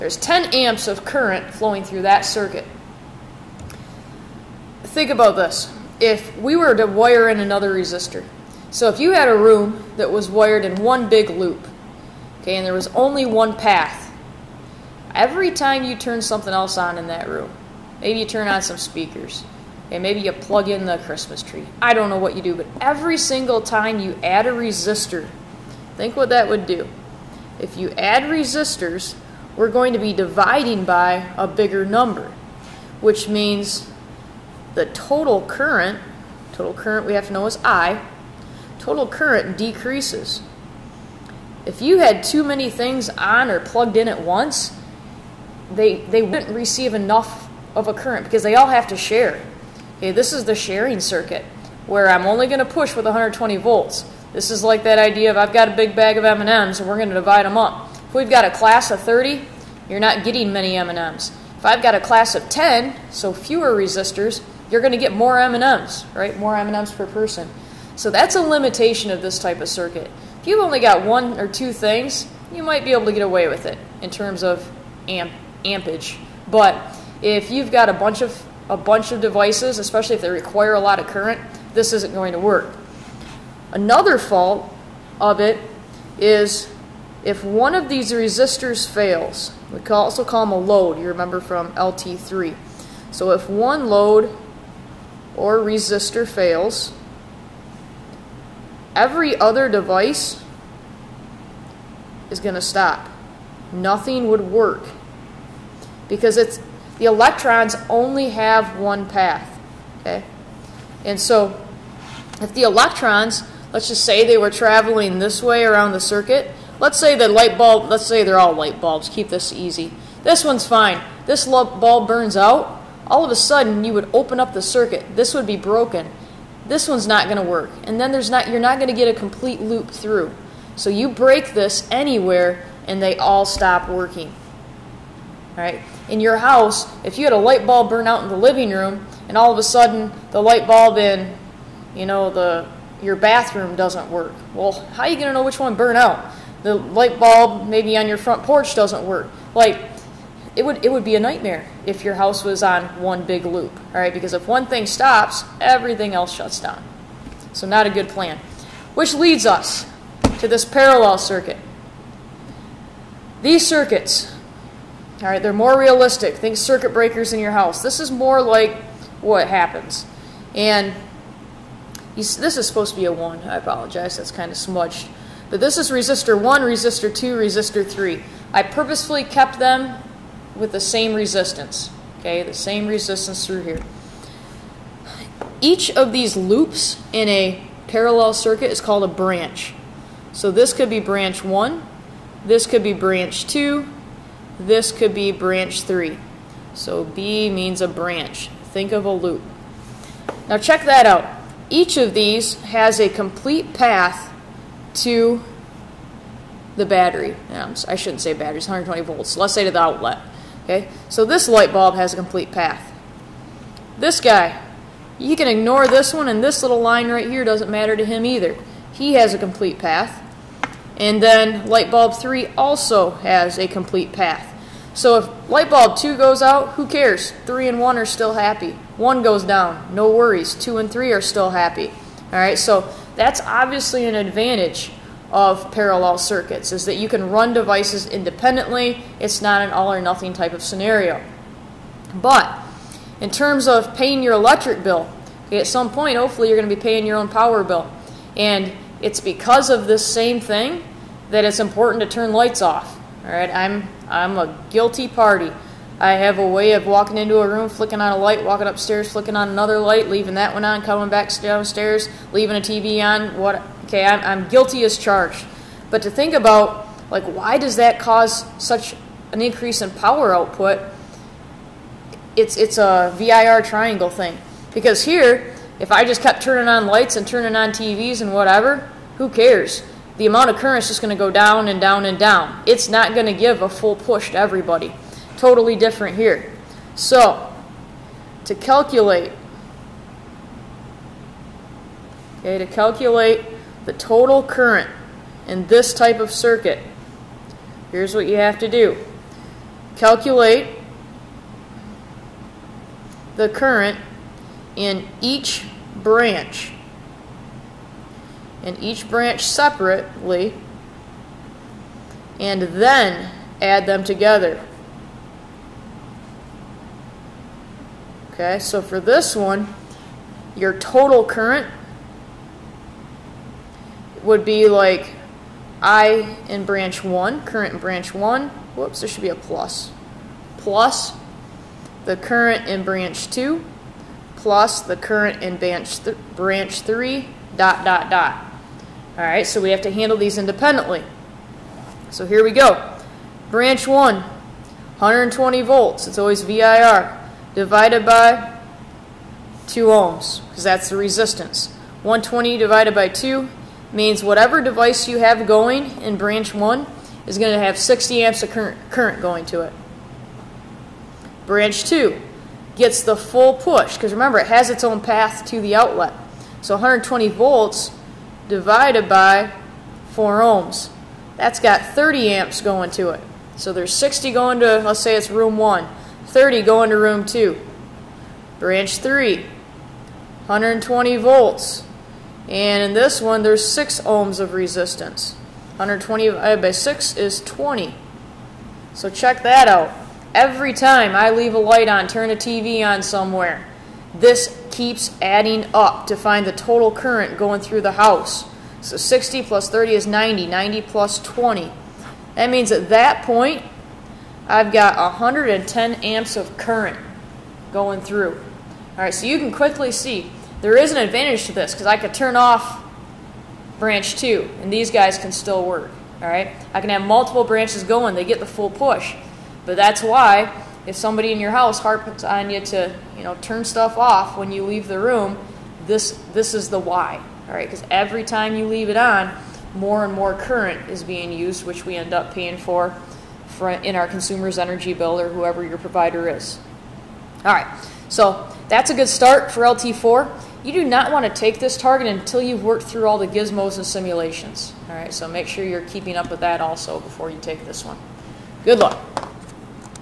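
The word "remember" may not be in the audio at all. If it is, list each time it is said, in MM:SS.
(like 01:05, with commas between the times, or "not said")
01:31, 06:04.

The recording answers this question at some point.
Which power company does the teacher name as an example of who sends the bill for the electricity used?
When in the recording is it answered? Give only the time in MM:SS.
07:14.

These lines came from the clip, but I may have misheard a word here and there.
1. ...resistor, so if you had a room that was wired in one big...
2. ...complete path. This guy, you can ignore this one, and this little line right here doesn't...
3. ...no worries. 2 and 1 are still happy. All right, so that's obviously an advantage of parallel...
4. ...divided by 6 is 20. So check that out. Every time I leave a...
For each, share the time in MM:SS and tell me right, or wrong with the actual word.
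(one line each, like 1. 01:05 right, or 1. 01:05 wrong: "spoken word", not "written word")
1. 00:07 right
2. 03:32 right
3. 03:49 wrong: "3", not "1"
4. 06:26 right.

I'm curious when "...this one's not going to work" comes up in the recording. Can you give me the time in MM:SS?
02:06.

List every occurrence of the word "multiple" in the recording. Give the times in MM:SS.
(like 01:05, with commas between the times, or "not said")
06:57.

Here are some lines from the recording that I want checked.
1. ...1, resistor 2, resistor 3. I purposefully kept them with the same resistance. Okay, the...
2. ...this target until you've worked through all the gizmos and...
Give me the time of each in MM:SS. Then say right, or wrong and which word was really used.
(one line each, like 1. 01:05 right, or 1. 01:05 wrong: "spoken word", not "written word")
1. 02:56 right
2. 07:21 right.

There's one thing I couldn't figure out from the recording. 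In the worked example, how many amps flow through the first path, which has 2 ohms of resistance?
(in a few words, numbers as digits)
60 amps.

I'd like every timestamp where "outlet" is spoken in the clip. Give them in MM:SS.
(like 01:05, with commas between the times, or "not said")
03:29, 06:05.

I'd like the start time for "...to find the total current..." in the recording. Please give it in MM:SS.
06:36.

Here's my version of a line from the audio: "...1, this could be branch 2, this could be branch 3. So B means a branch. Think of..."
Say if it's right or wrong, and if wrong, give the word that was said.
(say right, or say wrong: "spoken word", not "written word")
right.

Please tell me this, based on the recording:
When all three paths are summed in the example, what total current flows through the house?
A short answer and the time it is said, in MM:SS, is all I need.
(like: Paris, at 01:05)
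110 amps, at 06:44.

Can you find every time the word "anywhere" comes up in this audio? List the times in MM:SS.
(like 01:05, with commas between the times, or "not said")
02:11.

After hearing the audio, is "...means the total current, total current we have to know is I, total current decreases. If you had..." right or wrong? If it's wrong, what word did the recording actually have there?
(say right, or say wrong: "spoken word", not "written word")
right.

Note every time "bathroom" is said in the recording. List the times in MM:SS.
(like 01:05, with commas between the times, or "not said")
02:23.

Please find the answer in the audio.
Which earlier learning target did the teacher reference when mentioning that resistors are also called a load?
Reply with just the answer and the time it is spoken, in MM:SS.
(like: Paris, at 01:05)
LT3, at 01:31.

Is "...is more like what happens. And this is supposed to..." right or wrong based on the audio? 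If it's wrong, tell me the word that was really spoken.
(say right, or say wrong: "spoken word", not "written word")
right.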